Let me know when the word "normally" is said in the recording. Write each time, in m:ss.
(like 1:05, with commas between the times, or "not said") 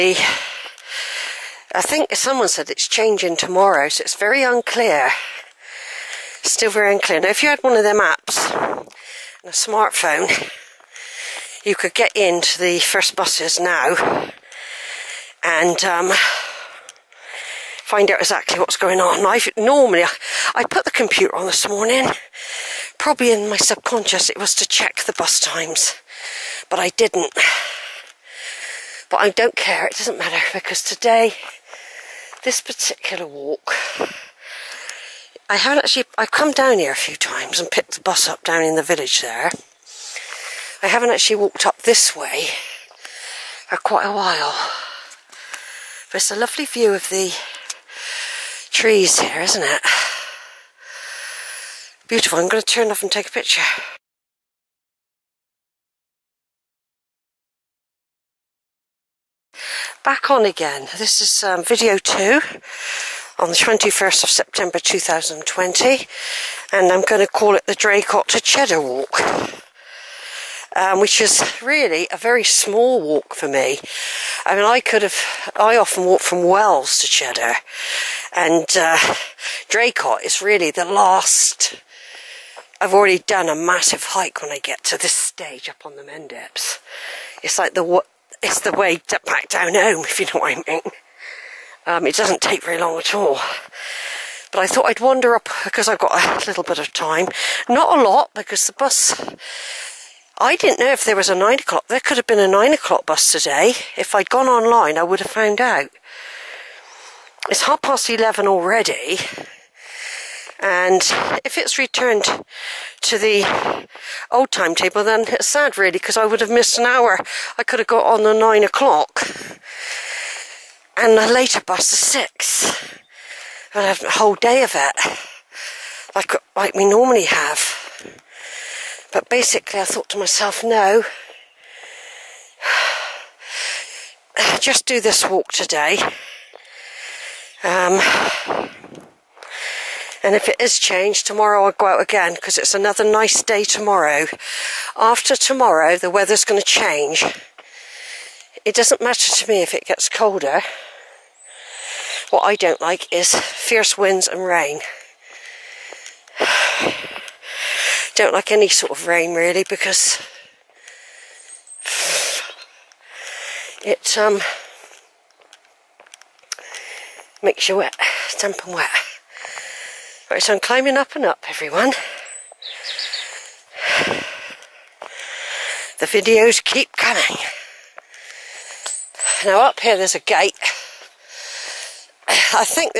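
0:19, 2:06.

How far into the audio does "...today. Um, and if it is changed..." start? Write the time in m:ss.
2:15.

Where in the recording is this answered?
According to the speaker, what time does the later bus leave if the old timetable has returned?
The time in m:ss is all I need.
2:01.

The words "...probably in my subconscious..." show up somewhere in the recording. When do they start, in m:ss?
0:22.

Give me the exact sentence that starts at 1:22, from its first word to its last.
I've already done a massive hike when I get to this stage up on the Mendips.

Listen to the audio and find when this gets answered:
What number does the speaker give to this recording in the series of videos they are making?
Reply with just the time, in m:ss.
1:01.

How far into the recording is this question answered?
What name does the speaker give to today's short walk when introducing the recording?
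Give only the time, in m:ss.
1:07.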